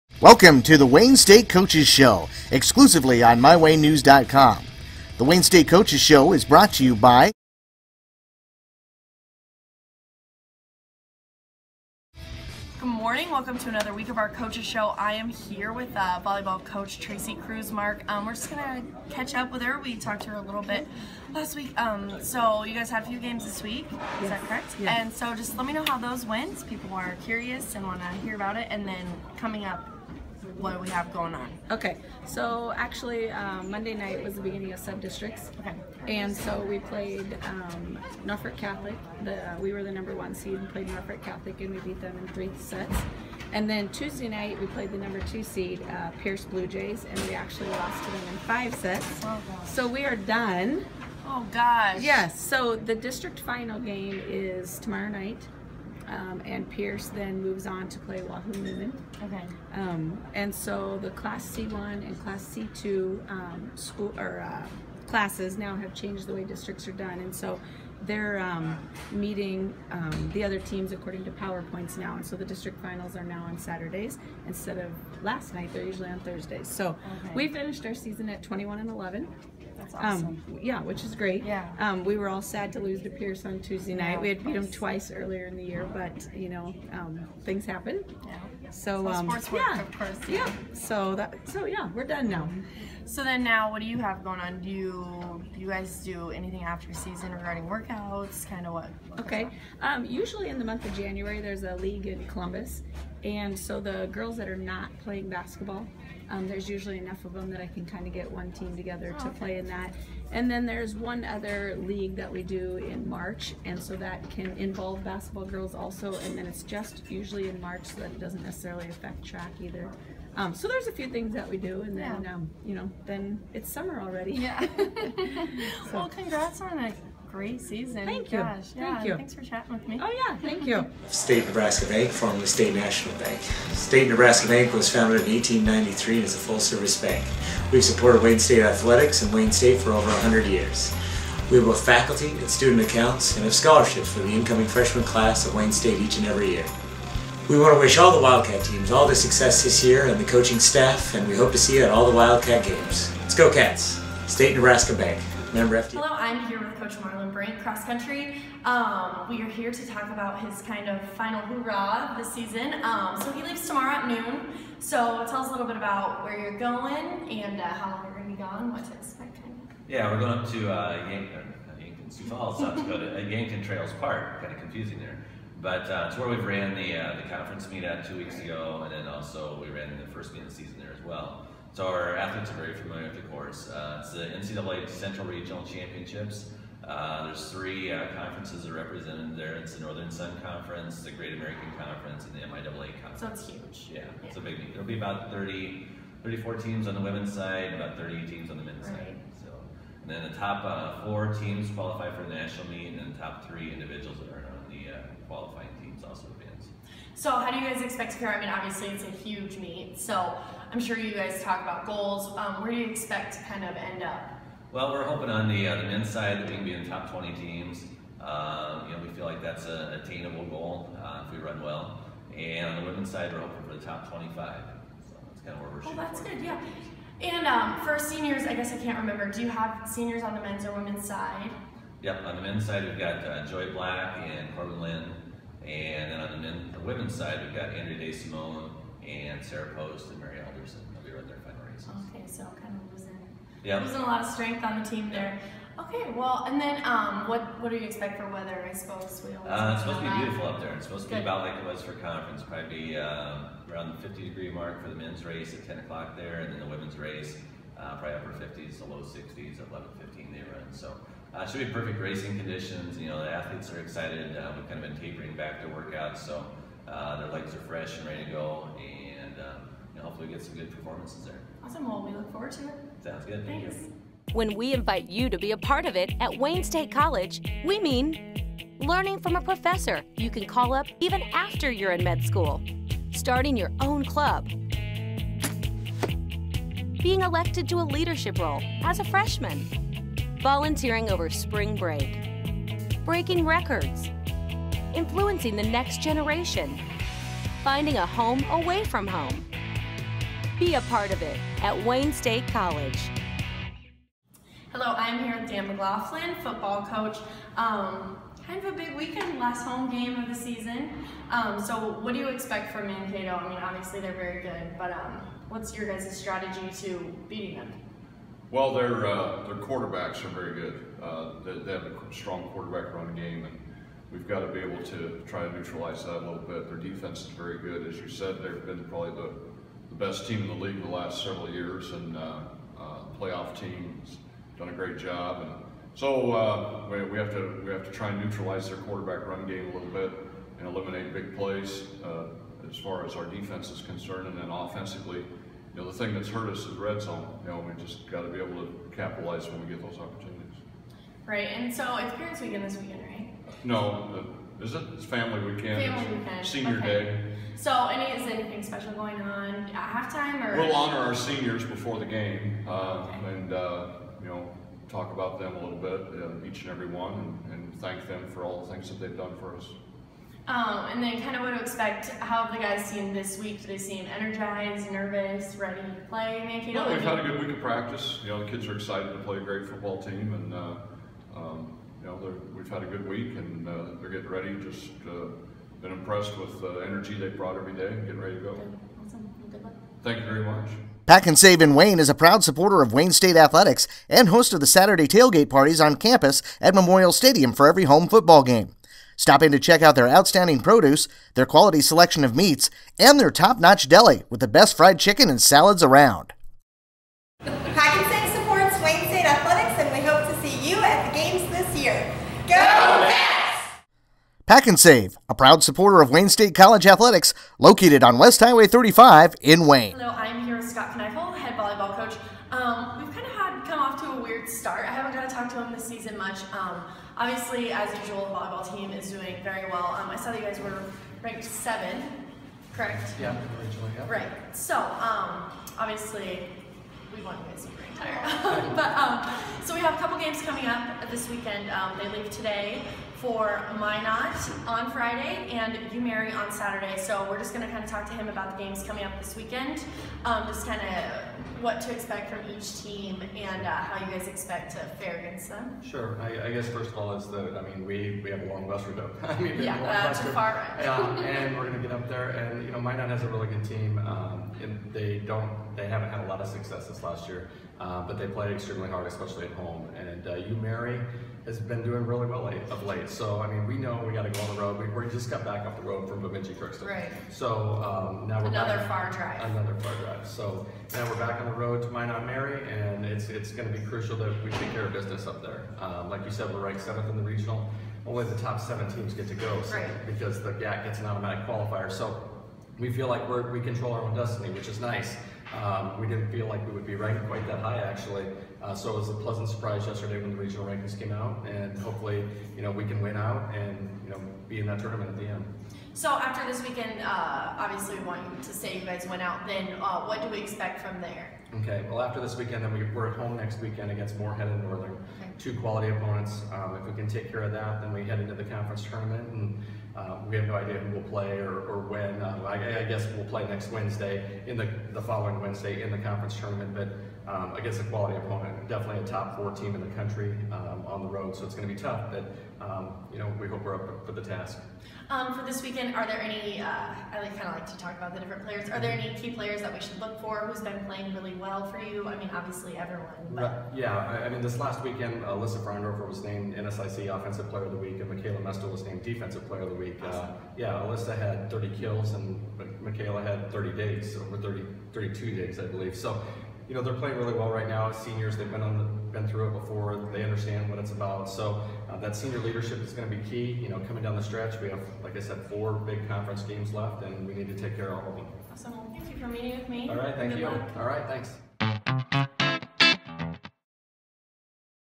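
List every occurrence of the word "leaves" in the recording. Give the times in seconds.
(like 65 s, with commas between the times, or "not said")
163 s, 442 s.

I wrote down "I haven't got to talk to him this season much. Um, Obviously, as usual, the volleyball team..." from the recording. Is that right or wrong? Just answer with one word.
right.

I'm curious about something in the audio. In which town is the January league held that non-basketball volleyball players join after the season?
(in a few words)
Columbus.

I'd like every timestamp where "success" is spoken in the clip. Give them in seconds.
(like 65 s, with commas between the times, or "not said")
149 s, 466 s.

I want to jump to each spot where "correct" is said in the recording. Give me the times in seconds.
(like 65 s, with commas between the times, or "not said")
24 s, 432 s.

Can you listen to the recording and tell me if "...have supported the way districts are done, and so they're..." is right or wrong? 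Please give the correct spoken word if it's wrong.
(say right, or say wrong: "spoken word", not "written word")
wrong: "changed", not "supported".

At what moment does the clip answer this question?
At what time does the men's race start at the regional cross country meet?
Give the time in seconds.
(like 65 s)
255 s.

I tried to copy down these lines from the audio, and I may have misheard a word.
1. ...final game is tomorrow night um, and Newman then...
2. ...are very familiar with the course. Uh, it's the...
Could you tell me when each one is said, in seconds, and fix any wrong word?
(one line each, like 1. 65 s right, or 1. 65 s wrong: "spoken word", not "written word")
1. 53 s wrong: "Pierce", not "Newman"
2. 182 s right.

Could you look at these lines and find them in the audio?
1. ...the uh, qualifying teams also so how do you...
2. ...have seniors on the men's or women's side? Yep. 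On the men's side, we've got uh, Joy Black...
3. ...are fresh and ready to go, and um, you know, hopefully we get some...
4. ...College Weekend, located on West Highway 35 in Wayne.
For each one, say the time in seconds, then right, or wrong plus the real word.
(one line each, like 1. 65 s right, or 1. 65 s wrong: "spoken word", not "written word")
1. 204 s right
2. 229 s right
3. 267 s right
4. 416 s wrong: "Athletics", not "Weekend".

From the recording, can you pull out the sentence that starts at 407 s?
Save supports Wayne State Athletics, and we hope to see you at the games this year.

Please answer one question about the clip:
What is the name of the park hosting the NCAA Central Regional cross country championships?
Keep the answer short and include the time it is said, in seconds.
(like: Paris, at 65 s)
Yankton Trails Park, at 173 s.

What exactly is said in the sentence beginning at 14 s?
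I am here with uh, volleyball coach Traci Krusemark, um, we're just gonna catch up with her.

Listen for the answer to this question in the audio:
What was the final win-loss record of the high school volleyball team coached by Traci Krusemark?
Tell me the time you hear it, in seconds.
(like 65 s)
78 s.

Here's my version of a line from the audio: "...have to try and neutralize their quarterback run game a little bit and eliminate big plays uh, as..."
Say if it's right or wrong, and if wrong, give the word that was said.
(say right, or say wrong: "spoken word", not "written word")
right.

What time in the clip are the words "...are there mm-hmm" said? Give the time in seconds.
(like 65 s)
538 s.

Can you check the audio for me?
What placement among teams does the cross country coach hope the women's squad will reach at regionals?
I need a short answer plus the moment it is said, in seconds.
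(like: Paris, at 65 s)
Top 25, at 223 s.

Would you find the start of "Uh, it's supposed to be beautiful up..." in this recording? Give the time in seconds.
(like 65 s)
249 s.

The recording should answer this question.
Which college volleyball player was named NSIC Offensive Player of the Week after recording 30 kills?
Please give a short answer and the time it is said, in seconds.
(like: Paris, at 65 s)
Alyssa Frondorfer, at 545 s.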